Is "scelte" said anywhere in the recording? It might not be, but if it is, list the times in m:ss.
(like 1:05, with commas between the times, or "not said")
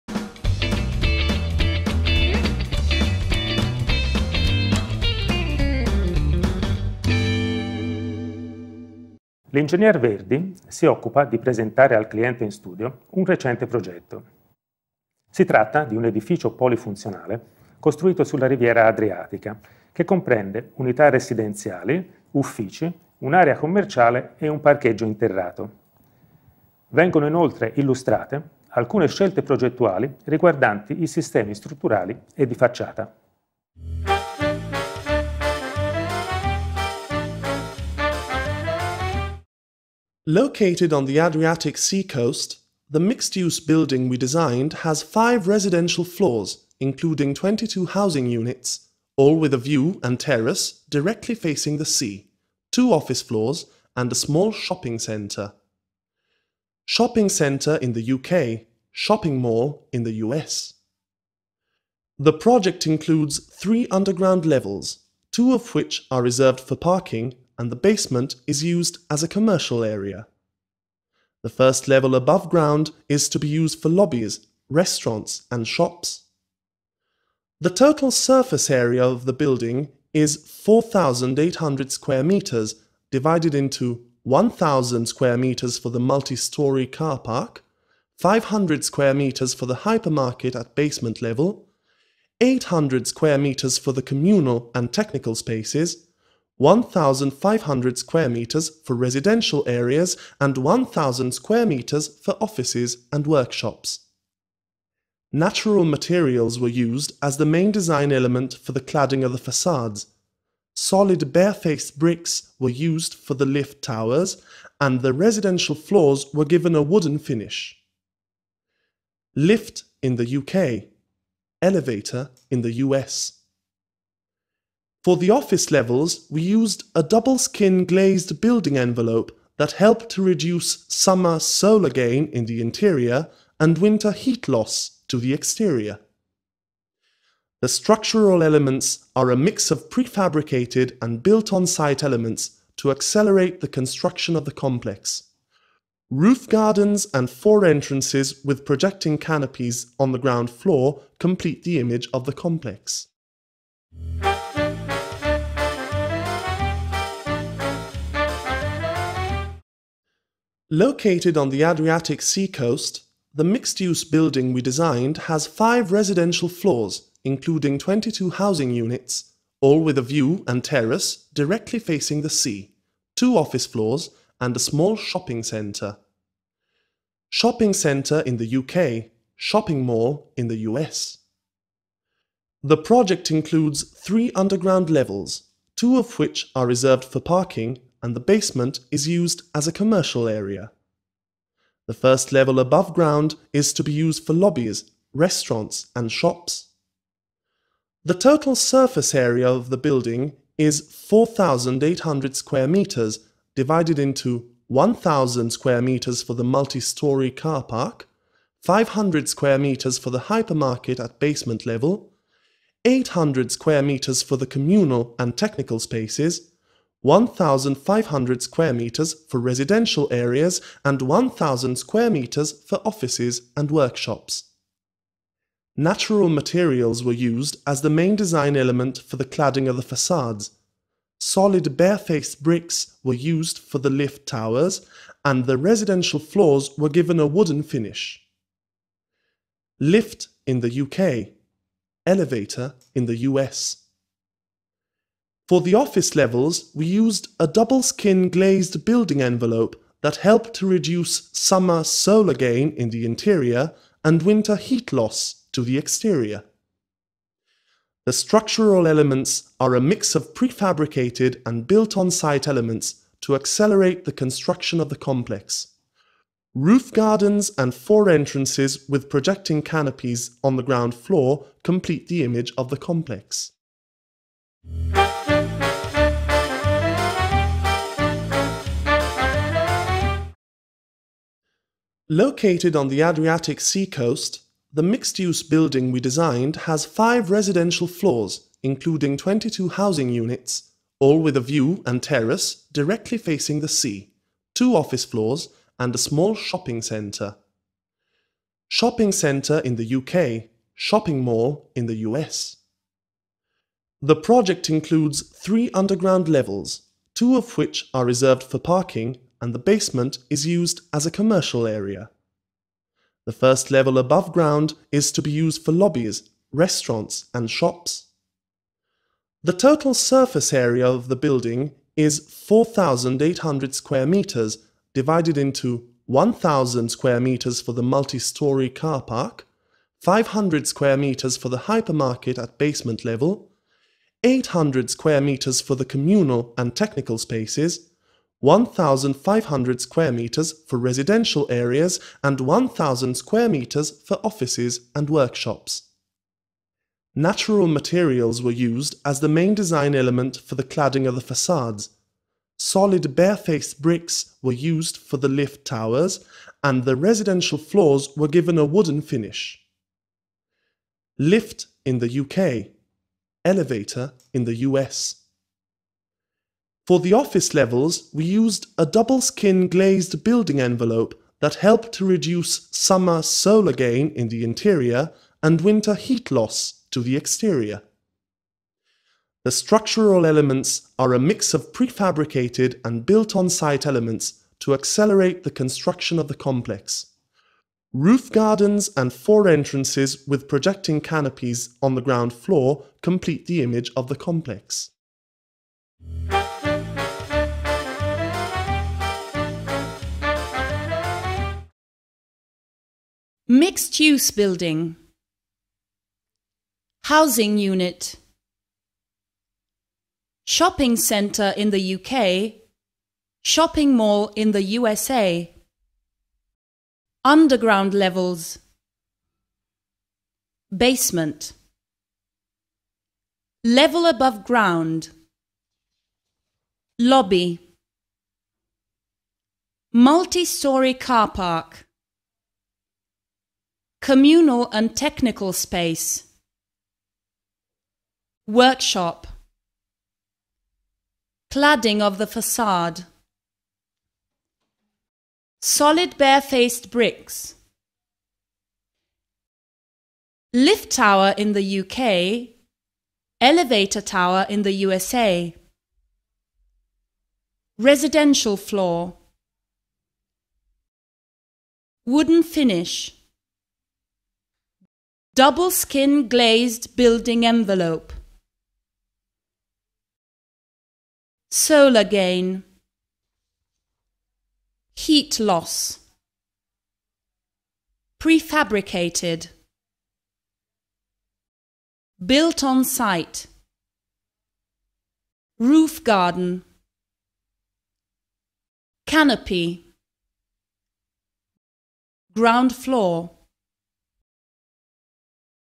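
0:29.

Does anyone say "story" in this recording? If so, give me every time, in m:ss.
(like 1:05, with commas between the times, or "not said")
1:26, 3:26, 5:27, 7:09.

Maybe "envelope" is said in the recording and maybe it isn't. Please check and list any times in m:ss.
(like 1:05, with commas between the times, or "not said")
2:08, 4:09, 6:10, 7:47.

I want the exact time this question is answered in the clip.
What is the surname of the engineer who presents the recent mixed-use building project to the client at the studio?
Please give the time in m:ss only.
0:09.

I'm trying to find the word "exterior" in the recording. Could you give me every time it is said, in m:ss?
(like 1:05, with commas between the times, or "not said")
2:15, 4:15, 6:17.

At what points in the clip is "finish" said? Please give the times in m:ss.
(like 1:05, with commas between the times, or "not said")
1:57, 3:57, 5:59, 7:42.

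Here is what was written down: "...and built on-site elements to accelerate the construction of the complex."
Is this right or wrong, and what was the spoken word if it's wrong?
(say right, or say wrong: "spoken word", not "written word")
right.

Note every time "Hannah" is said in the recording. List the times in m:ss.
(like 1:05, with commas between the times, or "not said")
not said.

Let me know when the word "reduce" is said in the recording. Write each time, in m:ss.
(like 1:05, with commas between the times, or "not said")
2:10, 4:10, 6:12.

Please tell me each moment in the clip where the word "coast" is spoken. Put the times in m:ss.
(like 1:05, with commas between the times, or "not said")
0:42, 2:42, 4:43.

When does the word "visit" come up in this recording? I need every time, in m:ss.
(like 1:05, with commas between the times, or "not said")
not said.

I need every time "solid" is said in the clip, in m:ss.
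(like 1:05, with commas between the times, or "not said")
1:50, 3:51, 5:52, 7:25.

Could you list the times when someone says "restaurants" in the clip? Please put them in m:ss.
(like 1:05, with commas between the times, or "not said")
1:14, 3:15, 5:16.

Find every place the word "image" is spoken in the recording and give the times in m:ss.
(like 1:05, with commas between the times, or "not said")
2:31, 4:32, 6:33.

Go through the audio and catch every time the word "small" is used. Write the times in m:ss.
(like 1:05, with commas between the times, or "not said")
0:54, 2:54, 4:55.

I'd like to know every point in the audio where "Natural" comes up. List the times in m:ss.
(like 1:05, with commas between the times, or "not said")
1:45, 3:45, 5:47.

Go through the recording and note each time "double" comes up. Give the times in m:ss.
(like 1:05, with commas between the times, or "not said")
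2:07, 4:07, 6:08, 7:45.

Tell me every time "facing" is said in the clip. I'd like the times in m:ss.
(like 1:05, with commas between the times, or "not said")
0:51, 2:51, 4:53.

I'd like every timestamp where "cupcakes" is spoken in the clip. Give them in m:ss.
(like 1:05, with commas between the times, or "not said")
not said.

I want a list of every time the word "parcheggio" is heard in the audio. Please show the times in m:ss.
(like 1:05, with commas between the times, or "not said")
0:24.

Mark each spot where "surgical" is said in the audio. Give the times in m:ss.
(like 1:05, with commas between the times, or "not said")
not said.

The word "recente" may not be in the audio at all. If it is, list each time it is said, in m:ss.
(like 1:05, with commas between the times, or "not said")
0:13.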